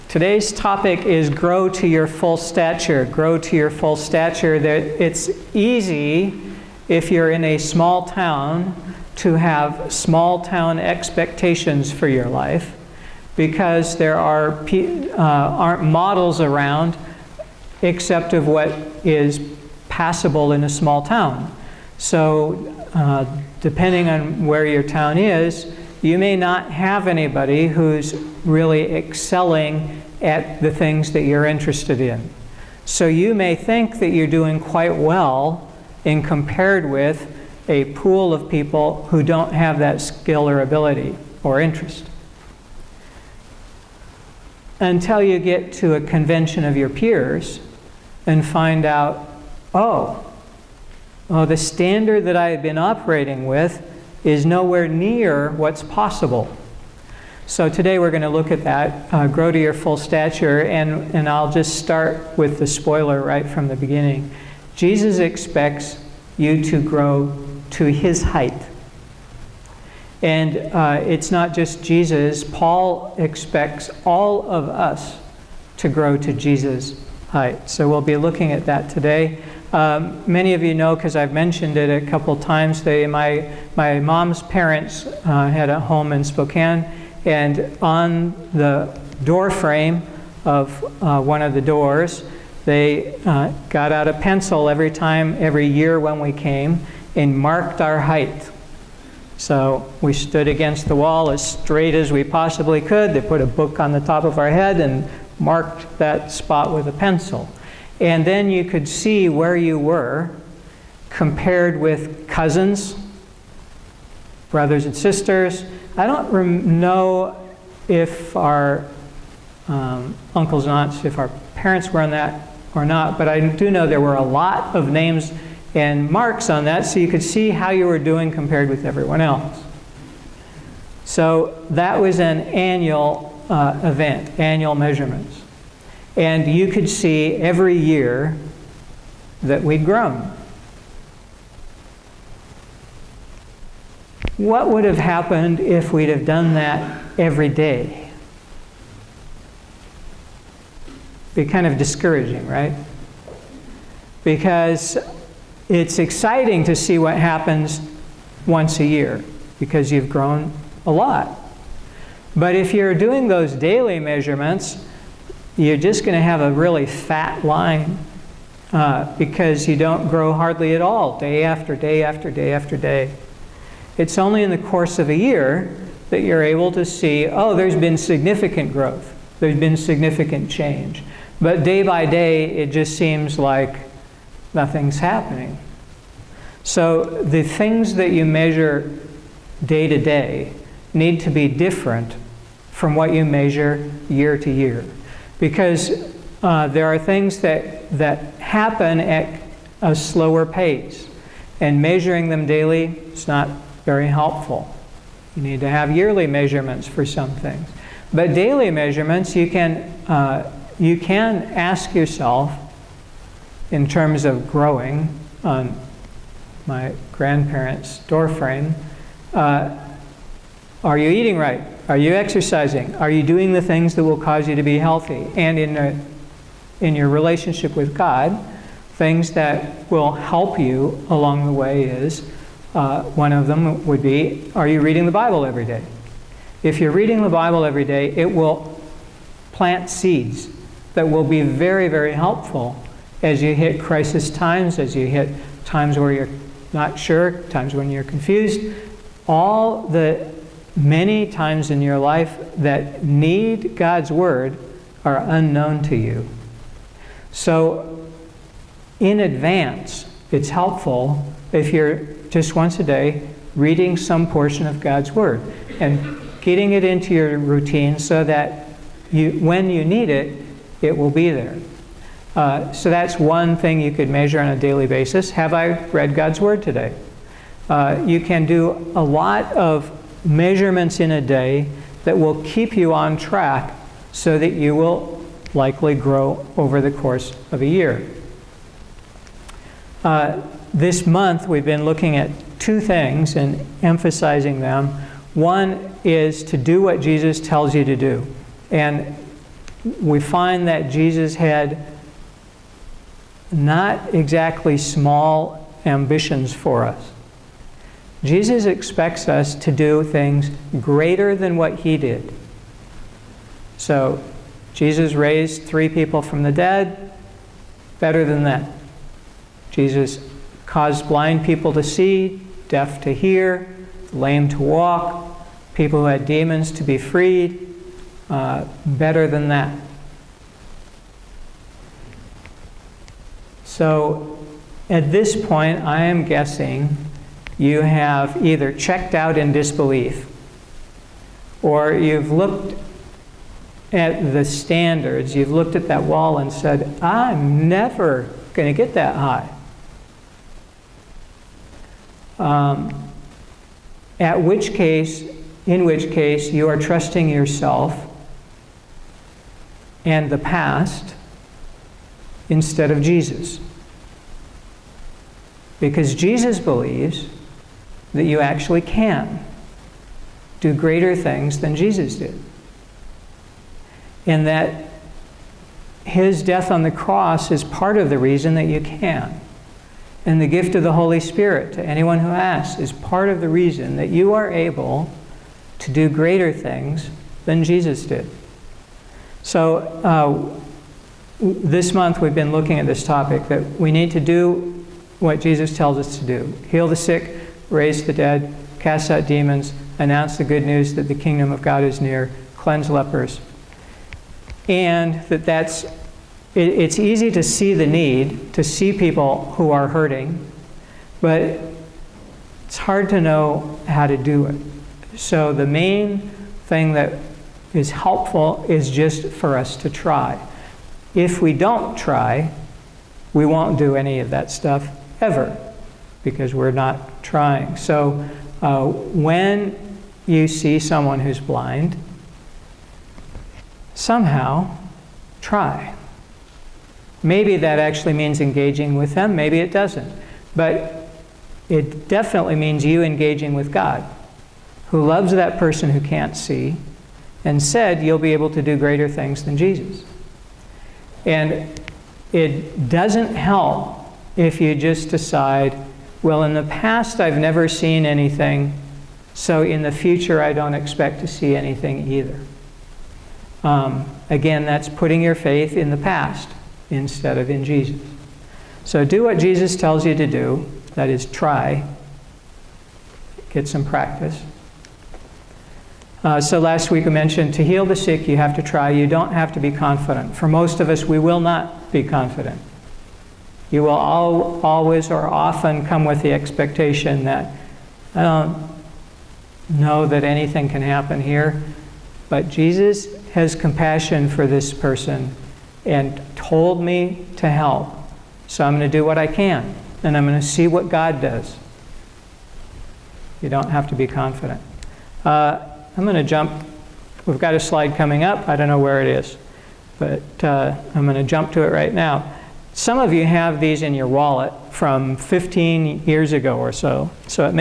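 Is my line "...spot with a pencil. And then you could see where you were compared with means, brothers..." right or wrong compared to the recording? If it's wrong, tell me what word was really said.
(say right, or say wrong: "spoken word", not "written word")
wrong: "cousins", not "means".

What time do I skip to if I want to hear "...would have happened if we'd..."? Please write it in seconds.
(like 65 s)
144 s.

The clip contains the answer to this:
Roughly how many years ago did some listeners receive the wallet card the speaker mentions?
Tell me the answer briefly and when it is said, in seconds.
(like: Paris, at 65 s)
15, at 515 s.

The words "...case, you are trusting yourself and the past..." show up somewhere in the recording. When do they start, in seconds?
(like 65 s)
356 s.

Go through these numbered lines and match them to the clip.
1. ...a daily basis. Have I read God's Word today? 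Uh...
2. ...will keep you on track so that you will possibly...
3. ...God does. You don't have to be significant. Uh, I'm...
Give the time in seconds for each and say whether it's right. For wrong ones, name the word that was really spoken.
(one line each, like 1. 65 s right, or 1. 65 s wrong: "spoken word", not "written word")
1. 274 s right
2. 282 s wrong: "likely", not "possibly"
3. 500 s wrong: "confident", not "significant".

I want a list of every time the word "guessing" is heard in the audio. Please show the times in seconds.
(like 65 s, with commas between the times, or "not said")
336 s.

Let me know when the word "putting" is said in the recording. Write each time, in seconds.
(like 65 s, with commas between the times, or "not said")
464 s.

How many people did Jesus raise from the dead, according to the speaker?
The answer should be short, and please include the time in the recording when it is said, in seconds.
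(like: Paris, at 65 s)
3, at 315 s.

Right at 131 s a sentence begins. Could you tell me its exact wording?
So that was an annual uh, event, annual measurements.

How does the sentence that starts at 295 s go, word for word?
One is to do what Jesus tells you to do.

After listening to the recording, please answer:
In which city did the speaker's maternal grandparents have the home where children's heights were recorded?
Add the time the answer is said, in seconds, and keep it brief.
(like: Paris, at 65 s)
Spokane, at 86 s.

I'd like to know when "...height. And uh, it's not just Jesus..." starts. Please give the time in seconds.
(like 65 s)
68 s.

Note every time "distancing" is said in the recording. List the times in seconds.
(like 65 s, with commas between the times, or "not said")
not said.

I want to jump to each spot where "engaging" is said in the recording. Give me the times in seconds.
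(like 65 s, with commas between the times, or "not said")
438 s, 443 s.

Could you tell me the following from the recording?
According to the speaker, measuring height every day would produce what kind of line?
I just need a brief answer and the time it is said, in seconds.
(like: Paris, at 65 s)
A really fat line, at 166 s.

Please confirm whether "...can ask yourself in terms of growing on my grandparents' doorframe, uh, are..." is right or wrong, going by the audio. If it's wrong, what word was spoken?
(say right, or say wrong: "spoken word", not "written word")
right.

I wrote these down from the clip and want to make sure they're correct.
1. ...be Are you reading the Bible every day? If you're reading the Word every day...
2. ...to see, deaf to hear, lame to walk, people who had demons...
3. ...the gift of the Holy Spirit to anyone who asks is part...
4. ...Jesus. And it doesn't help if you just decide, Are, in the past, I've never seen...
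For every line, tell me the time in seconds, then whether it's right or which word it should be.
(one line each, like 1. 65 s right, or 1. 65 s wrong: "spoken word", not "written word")
1. 234 s wrong: "Bible", not "Word"
2. 321 s right
3. 380 s right
4. 449 s wrong: "Well", not "Are".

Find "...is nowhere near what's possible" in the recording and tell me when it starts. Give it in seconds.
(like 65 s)
54 s.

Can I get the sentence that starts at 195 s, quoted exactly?
Because uh, there are things that, that happen at a slower pace.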